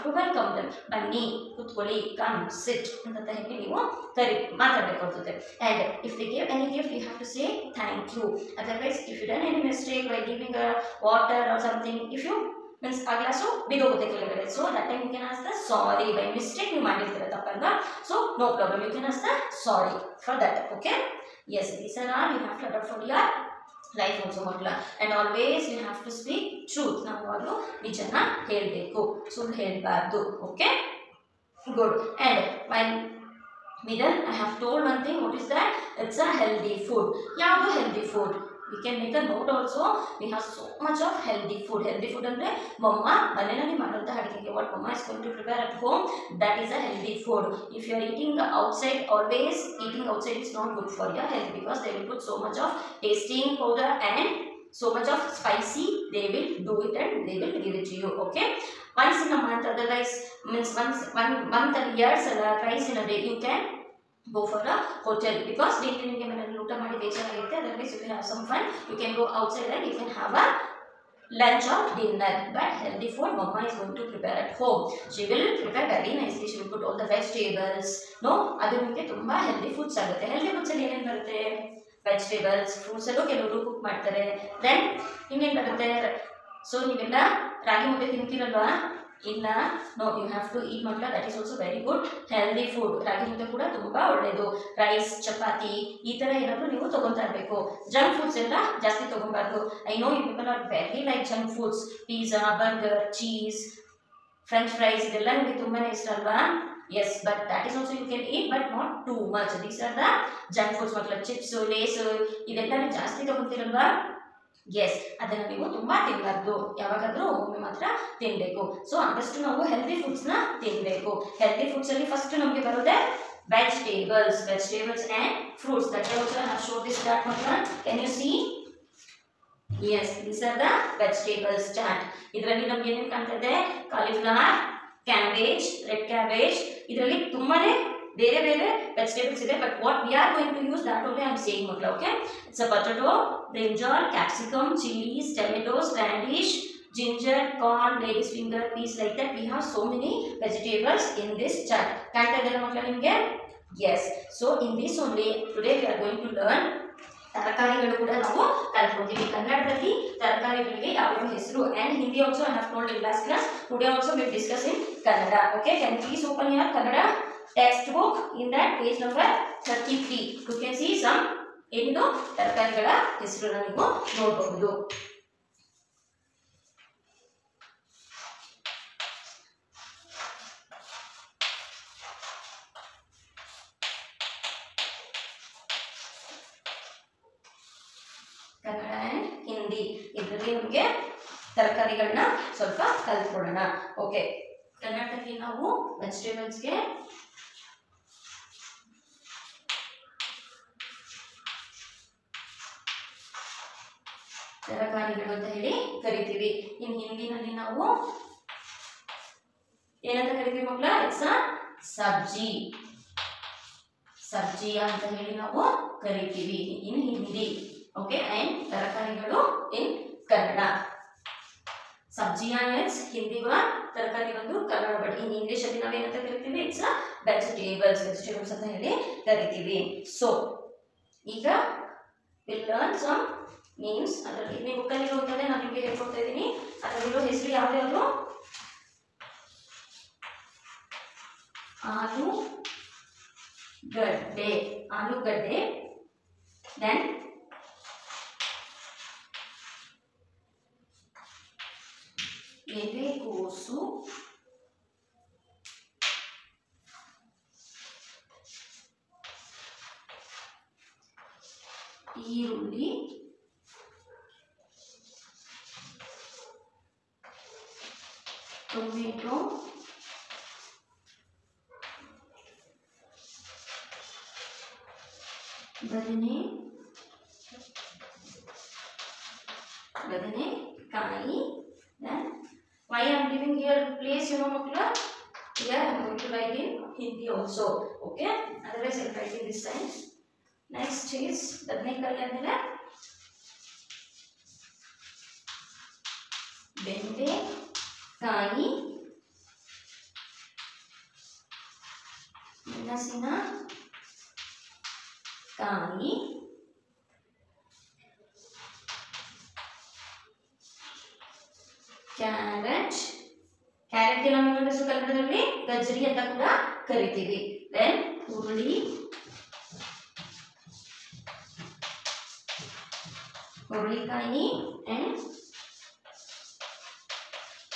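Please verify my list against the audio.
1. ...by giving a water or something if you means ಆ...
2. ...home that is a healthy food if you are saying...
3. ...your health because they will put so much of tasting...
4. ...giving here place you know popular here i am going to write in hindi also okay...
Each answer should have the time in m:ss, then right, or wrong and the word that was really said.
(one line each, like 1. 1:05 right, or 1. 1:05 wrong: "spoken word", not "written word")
1. 0:10 right
2. 0:45 wrong: "eating", not "saying"
3. 0:51 right
4. 4:43 right.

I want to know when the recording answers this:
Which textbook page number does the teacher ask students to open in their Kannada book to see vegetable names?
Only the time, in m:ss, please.
2:48.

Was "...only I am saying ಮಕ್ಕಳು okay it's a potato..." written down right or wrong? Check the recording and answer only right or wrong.
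right.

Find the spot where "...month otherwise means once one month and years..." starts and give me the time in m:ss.
0:59.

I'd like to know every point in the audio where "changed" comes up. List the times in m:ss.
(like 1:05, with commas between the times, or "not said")
not said.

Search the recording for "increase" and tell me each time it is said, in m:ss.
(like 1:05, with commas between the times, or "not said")
not said.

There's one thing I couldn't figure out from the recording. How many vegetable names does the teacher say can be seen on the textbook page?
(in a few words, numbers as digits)
8.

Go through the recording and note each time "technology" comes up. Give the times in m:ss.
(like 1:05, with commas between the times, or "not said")
not said.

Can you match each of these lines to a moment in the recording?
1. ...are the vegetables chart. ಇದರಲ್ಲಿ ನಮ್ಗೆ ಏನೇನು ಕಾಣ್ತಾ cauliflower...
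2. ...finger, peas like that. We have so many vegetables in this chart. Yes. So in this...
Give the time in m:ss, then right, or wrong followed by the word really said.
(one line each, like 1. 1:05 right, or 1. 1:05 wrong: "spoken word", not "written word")
1. 2:10 right
2. 2:28 right.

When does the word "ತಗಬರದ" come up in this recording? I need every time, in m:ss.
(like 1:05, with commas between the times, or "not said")
1:39.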